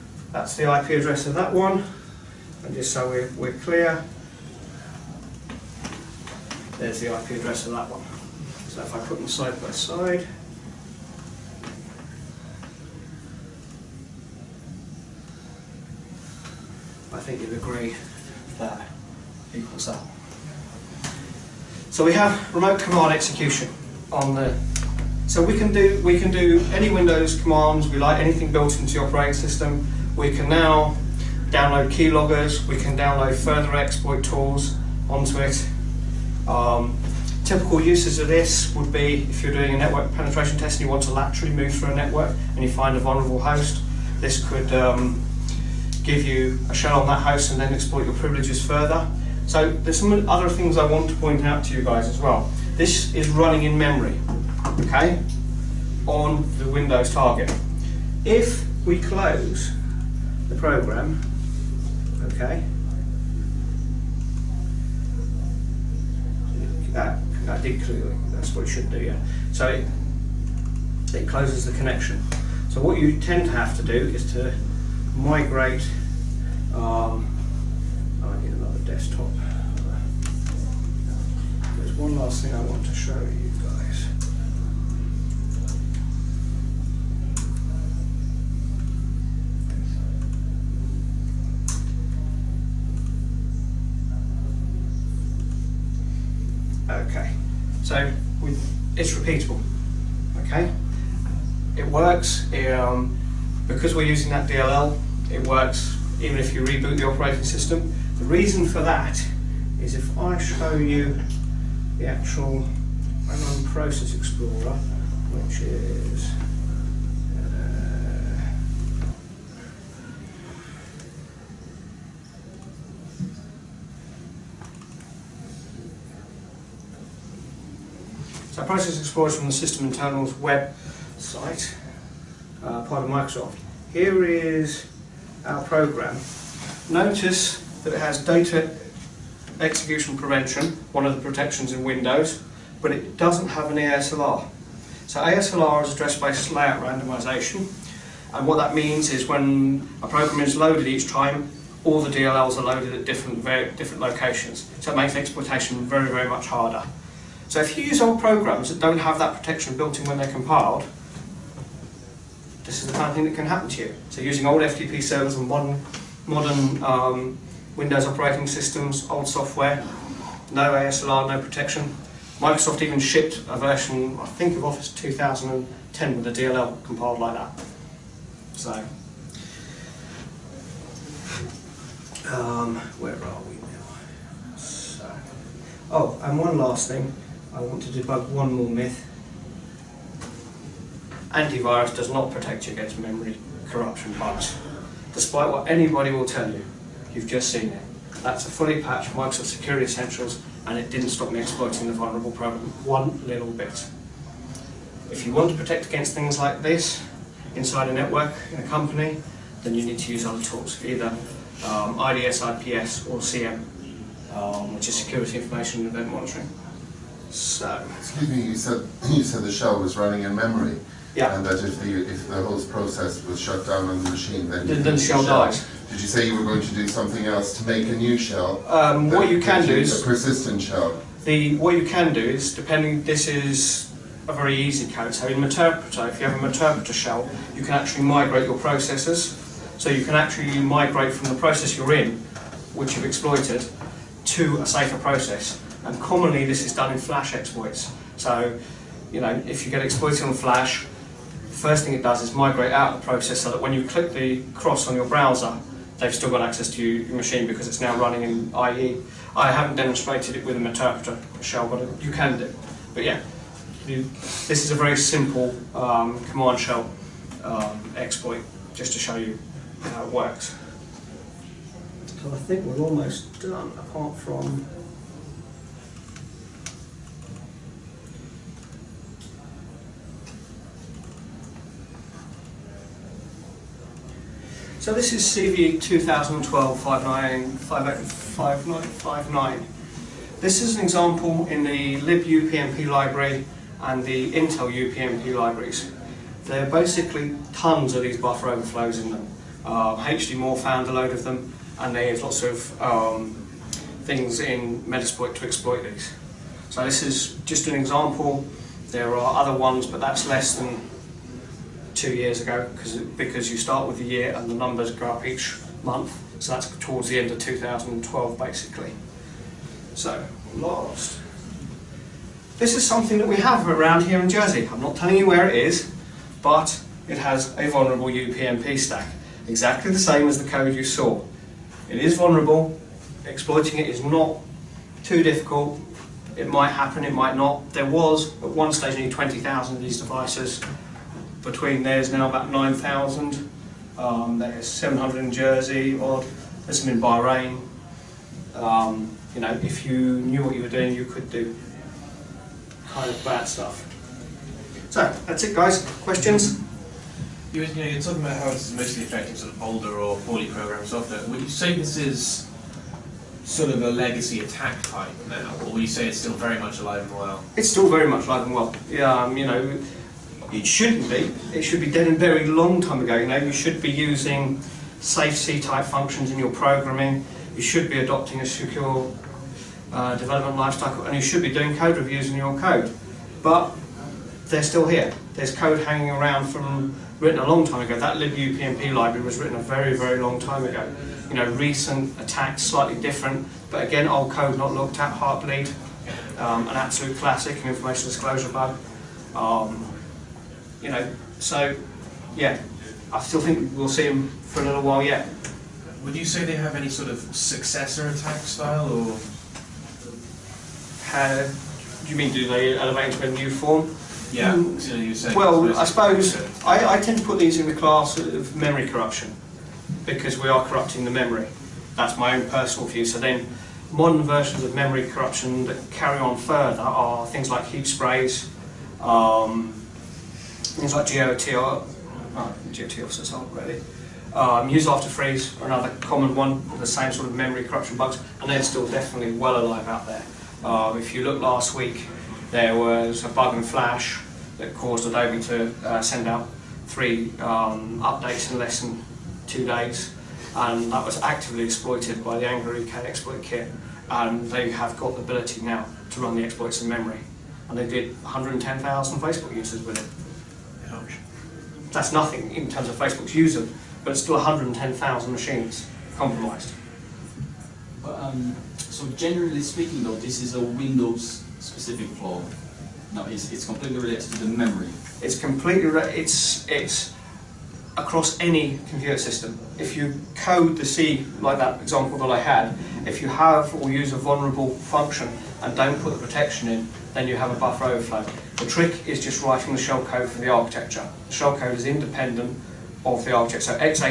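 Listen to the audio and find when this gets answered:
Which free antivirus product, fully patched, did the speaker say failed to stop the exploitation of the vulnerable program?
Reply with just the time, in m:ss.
3:19.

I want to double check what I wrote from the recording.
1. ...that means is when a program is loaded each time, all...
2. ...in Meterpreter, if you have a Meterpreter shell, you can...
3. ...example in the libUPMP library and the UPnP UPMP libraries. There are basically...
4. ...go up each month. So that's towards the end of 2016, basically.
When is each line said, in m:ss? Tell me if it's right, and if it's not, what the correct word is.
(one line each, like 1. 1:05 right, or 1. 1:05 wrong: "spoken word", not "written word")
1. 2:28 right
2. 3:55 right
3. 4:50 wrong: "Intel", not "UPnP"
4. 5:14 wrong: "2012", not "2016".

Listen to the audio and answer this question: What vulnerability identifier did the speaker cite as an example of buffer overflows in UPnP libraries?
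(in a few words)
CVE-2012-5959.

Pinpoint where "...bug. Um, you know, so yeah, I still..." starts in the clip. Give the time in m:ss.
6:38.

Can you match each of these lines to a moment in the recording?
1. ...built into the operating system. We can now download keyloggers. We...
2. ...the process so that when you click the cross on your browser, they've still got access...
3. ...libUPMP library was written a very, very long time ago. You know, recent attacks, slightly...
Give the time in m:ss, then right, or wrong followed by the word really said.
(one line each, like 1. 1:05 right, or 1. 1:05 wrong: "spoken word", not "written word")
1. 0:28 right
2. 4:13 right
3. 6:28 right.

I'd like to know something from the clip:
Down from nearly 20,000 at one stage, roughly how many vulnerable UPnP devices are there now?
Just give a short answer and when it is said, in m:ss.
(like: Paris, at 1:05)
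9,000, at 5:42.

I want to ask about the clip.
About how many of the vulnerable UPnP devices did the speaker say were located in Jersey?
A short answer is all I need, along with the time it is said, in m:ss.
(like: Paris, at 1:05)
700, at 5:44.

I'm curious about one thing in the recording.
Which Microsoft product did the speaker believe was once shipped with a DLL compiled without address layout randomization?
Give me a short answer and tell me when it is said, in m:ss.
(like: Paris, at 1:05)
Office 2010, at 2:54.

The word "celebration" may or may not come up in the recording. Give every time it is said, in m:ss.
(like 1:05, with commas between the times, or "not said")
not said.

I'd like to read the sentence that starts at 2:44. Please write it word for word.
So using old FTP servers and modern, modern um, Windows operating systems, old software, no ASLR, no protection.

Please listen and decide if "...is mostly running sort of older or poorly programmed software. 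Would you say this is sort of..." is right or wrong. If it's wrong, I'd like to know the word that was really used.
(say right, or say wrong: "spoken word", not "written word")
wrong: "affecting", not "running".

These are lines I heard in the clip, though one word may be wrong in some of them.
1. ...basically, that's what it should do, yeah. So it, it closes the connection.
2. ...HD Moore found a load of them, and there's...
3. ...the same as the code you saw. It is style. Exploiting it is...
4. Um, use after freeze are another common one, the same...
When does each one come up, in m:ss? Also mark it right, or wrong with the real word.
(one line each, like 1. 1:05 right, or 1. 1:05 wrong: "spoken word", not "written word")
1. 1:07 wrong: "clearly", not "basically"
2. 5:00 right
3. 5:29 wrong: "vulnerable", not "style"
4. 7:14 right.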